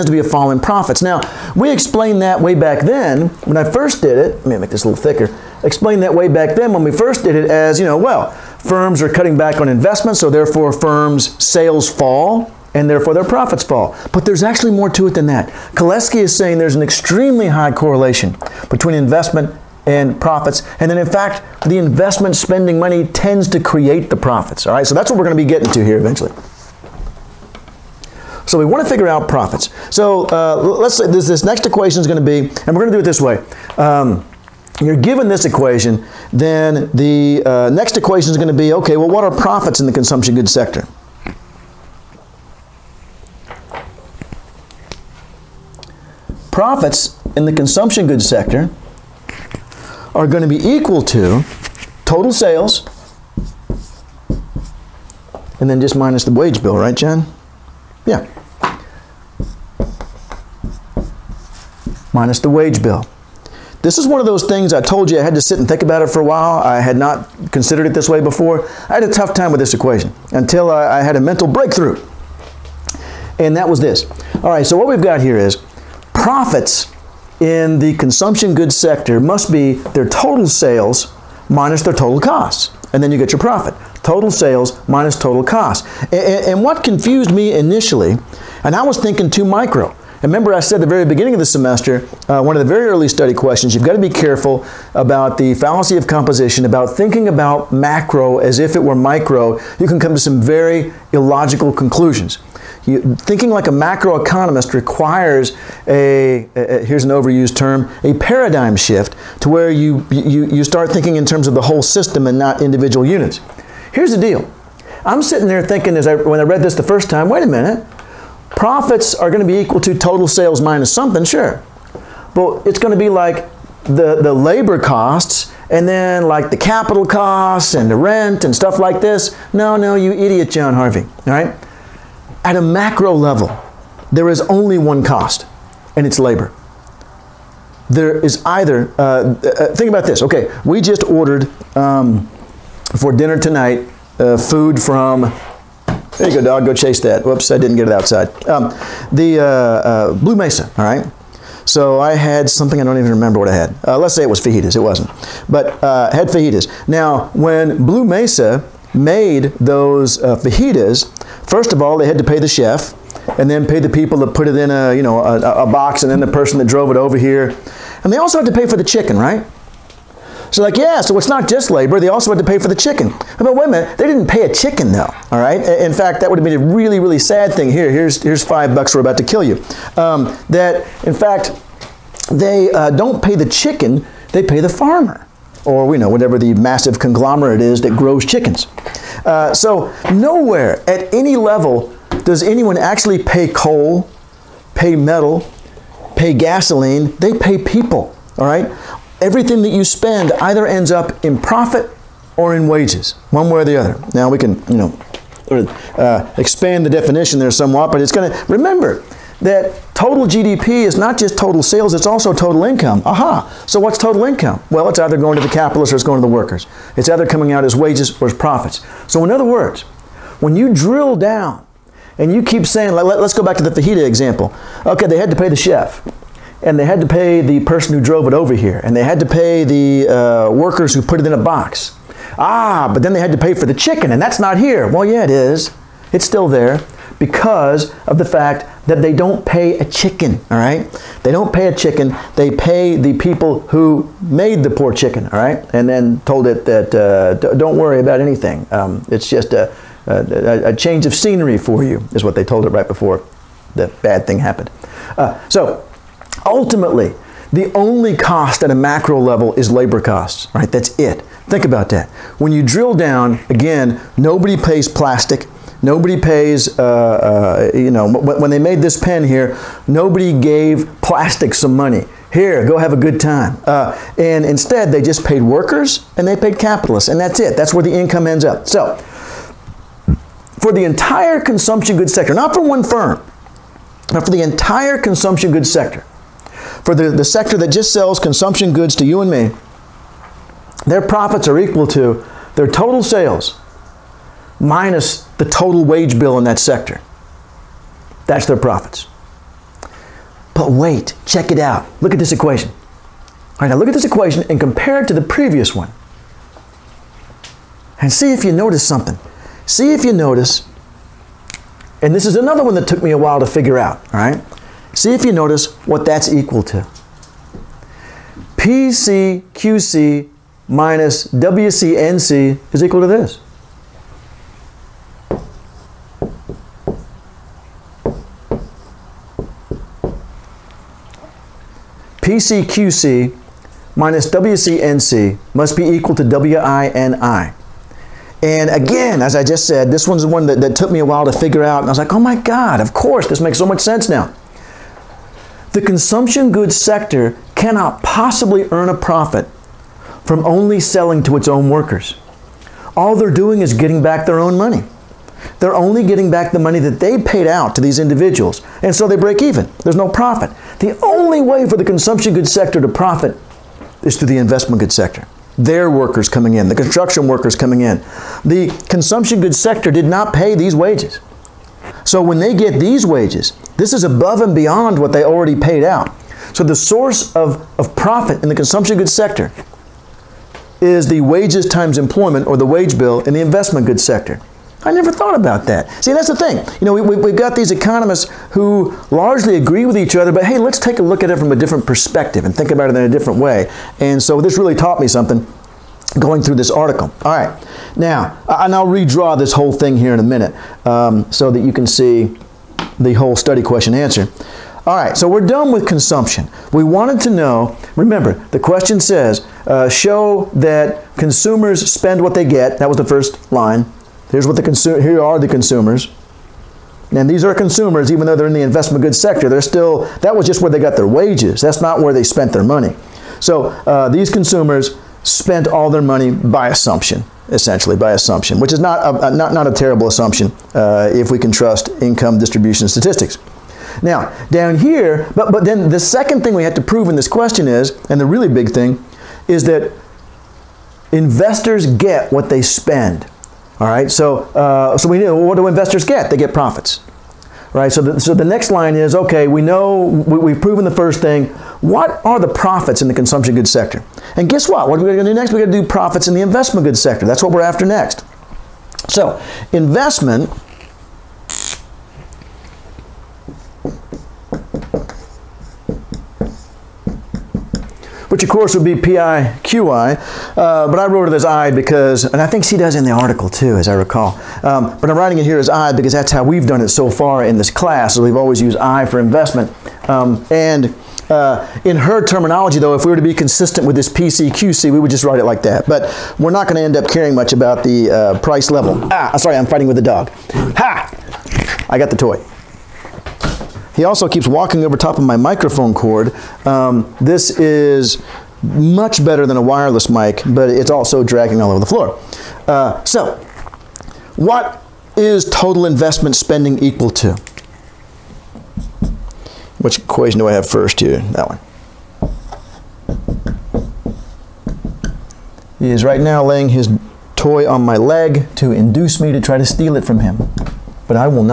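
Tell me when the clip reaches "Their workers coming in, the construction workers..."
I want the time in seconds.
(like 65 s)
365 s.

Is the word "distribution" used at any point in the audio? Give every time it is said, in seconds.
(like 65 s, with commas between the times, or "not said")
432 s.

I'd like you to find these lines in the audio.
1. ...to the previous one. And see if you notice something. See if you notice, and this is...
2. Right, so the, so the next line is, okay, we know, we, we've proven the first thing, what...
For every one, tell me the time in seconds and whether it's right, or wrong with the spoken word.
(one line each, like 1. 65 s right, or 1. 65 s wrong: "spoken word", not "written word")
1. 305 s right
2. 447 s right.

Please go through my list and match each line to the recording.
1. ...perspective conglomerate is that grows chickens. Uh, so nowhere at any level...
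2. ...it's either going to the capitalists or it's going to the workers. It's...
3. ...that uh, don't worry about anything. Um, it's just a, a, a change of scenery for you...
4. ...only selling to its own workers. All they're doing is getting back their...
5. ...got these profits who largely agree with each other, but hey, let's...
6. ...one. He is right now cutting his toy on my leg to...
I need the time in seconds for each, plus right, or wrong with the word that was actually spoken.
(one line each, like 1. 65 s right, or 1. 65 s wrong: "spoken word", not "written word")
1. 186 s wrong: "massive", not "perspective"
2. 214 s right
3. 246 s right
4. 350 s right
5. 387 s wrong: "economists", not "profits"
6. 511 s wrong: "laying", not "cutting".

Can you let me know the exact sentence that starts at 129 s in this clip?
No, no, you idiot, John Harvey.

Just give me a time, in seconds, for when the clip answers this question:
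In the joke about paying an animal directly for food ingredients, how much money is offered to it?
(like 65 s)
178 s.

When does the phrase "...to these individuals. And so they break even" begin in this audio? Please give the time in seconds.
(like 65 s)
357 s.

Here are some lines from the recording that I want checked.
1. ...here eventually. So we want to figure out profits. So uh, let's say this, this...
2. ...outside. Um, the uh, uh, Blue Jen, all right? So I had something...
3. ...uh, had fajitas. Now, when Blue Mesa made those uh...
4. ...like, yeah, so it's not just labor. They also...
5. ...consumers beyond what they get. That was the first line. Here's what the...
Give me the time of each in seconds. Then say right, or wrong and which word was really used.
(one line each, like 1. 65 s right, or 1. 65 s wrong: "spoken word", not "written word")
1. 25 s right
2. 147 s wrong: "Mesa", not "Jen"
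3. 155 s right
4. 170 s right
5. 411 s wrong: "spend", not "beyond".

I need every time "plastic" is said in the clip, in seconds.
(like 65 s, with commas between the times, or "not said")
264 s, 271 s.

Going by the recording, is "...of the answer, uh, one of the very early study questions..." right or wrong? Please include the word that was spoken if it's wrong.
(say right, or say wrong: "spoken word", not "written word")
wrong: "semester", not "answer".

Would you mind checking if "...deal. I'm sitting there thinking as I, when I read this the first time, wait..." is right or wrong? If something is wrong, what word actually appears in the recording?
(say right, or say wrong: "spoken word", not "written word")
right.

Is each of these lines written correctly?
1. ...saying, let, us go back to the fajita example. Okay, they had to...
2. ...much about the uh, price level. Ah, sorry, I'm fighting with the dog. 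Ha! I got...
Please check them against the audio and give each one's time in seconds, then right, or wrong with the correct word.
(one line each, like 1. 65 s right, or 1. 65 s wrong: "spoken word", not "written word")
1. 222 s right
2. 487 s right.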